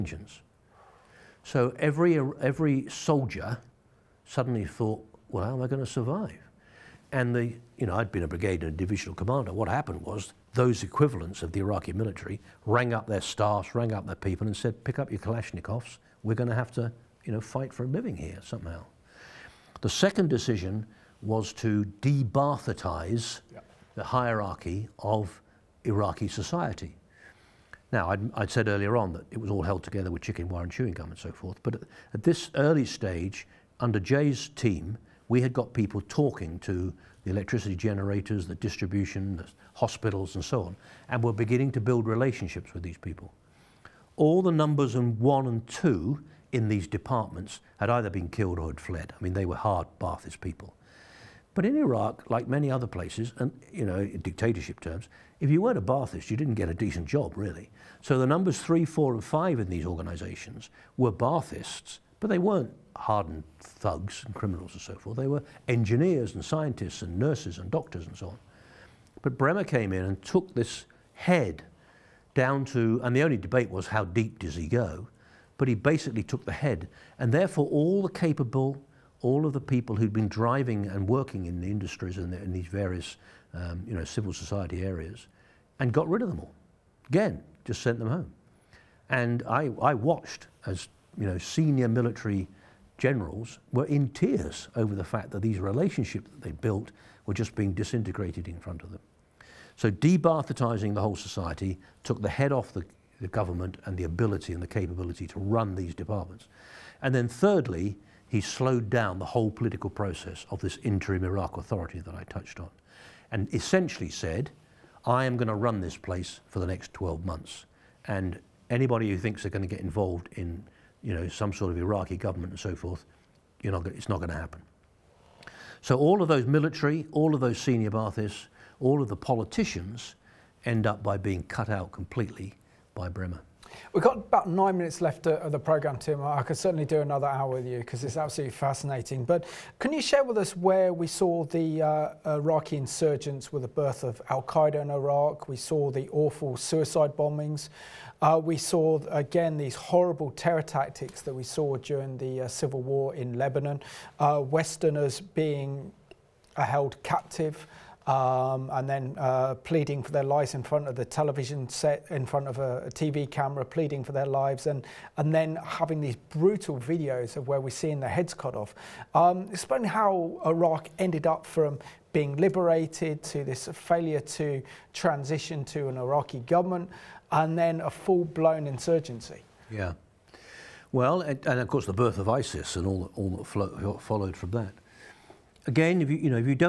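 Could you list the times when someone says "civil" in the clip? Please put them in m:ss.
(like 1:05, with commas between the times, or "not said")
1:24, 2:32.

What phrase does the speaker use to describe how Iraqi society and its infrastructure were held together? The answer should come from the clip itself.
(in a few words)
chicken wire and chewing gum.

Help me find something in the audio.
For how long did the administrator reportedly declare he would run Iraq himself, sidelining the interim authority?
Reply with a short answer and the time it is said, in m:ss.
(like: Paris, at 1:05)
12 months, at 1:56.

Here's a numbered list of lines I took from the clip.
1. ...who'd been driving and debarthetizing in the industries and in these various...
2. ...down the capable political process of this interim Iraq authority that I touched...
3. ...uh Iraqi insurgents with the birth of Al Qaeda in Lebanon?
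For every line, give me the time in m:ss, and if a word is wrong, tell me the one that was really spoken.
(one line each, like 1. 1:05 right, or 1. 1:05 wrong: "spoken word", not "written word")
1. 1:19 wrong: "working", not "debarthetizing"
2. 1:48 wrong: "whole", not "capable"
3. 2:22 wrong: "Iraq", not "Lebanon".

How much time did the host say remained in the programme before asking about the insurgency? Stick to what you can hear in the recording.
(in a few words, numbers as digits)
9 minutes.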